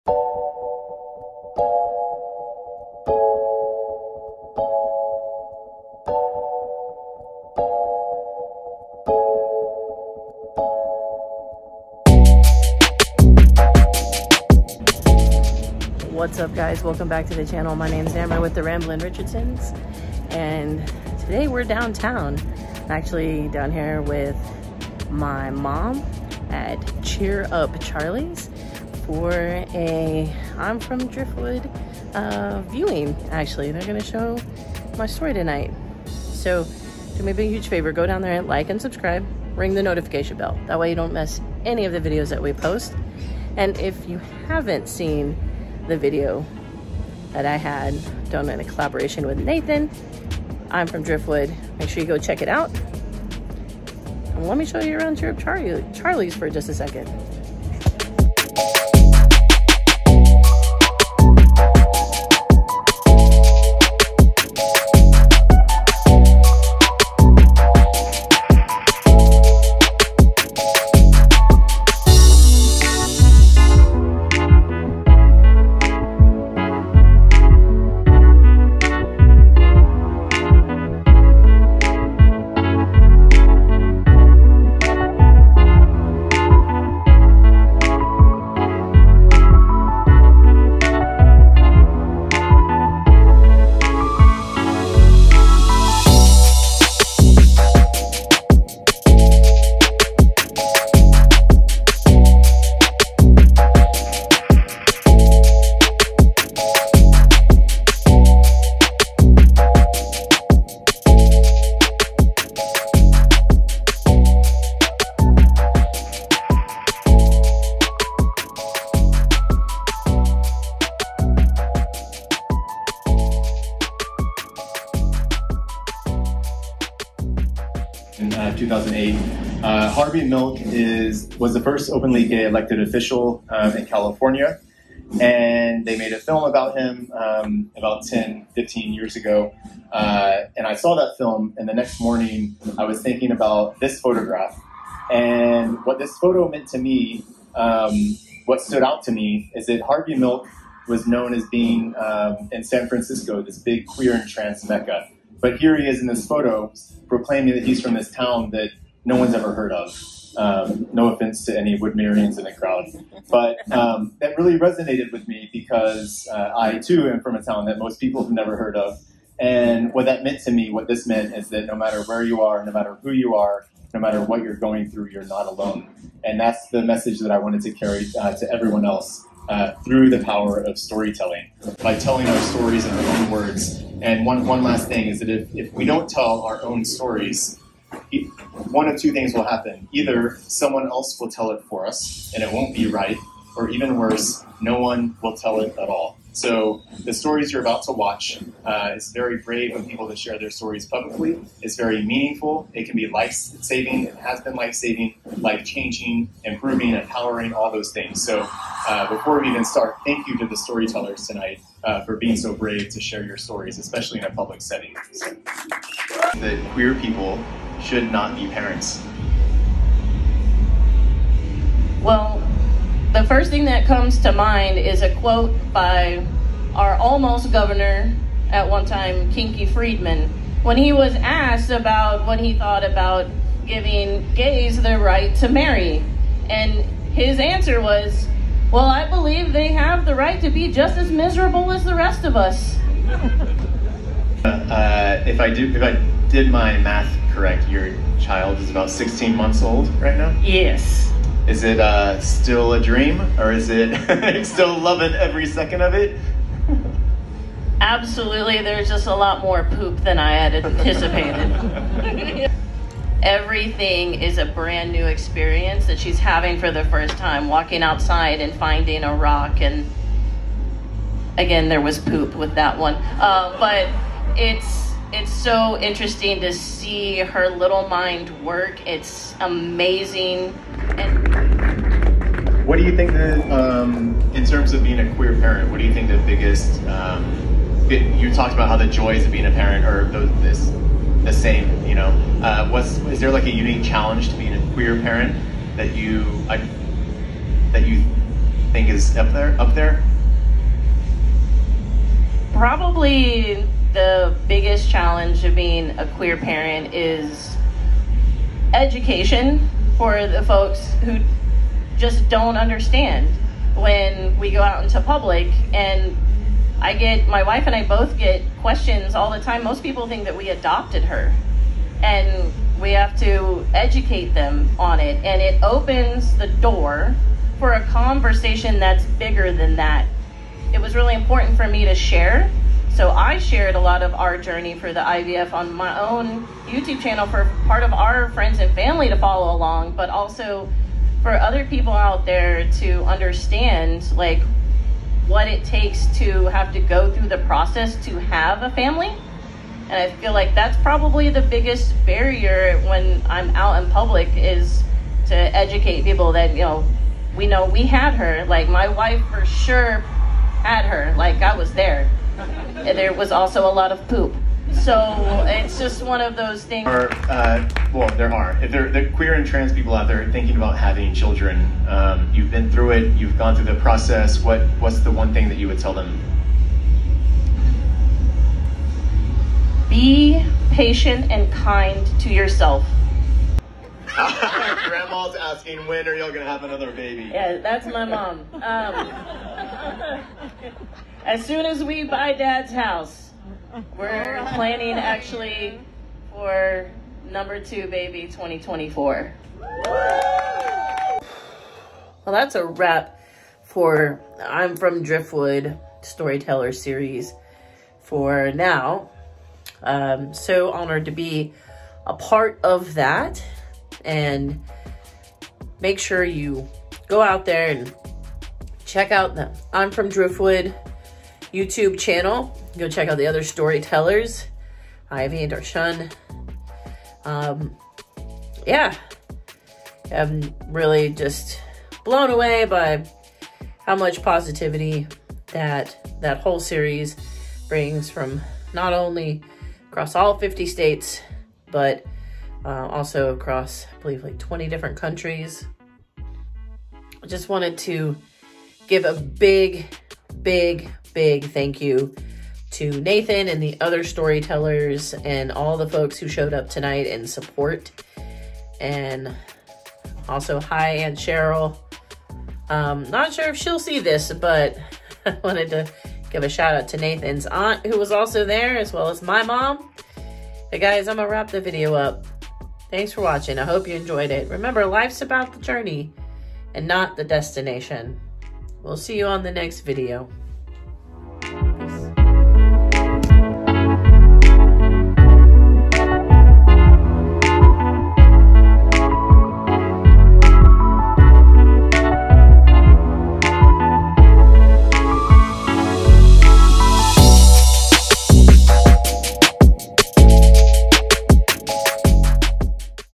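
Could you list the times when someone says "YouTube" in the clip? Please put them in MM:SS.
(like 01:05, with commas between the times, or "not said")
05:36, 07:01.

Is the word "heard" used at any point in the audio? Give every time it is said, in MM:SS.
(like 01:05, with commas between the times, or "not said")
02:39, 02:48.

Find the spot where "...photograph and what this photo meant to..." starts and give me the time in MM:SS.
02:23.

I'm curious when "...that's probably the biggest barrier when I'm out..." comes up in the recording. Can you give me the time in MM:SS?
05:50.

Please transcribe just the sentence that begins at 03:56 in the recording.
And his answer was, Well, I believe they have the right to be just as miserable as the rest of us.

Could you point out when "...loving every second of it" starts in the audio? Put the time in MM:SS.
04:14.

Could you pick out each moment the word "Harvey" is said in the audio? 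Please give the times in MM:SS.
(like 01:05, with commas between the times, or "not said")
02:09, 02:29.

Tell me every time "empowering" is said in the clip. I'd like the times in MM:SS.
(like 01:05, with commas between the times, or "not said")
03:26.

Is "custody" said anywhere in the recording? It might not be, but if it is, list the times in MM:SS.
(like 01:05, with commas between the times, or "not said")
not said.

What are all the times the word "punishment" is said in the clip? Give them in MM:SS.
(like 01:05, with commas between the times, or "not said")
not said.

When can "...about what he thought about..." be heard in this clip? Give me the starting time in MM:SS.
03:51.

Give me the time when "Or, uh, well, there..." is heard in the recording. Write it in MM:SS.
06:06.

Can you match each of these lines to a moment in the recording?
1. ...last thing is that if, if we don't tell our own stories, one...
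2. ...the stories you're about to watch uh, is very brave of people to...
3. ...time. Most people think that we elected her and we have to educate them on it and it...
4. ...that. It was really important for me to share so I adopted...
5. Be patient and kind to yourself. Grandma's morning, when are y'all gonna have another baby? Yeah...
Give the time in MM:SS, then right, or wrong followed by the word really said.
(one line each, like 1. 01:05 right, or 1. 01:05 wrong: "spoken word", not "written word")
1. 03:04 right
2. 03:17 right
3. 05:19 wrong: "adopted", not "elected"
4. 05:29 wrong: "shared", not "adopted"
5. 06:19 wrong: "asking", not "morning".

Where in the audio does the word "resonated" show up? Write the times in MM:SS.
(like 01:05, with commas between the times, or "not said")
02:44.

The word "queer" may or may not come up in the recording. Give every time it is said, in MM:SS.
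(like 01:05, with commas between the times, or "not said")
02:33, 03:36, 04:45, 04:54, 05:06, 06:09.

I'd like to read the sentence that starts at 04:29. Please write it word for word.
And again, there was poop with that one.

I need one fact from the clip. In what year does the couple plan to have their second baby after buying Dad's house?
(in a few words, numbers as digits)
2024.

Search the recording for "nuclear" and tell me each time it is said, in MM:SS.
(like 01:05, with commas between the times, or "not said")
not said.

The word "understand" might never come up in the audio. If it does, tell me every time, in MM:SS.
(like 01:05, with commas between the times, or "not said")
05:12, 05:43.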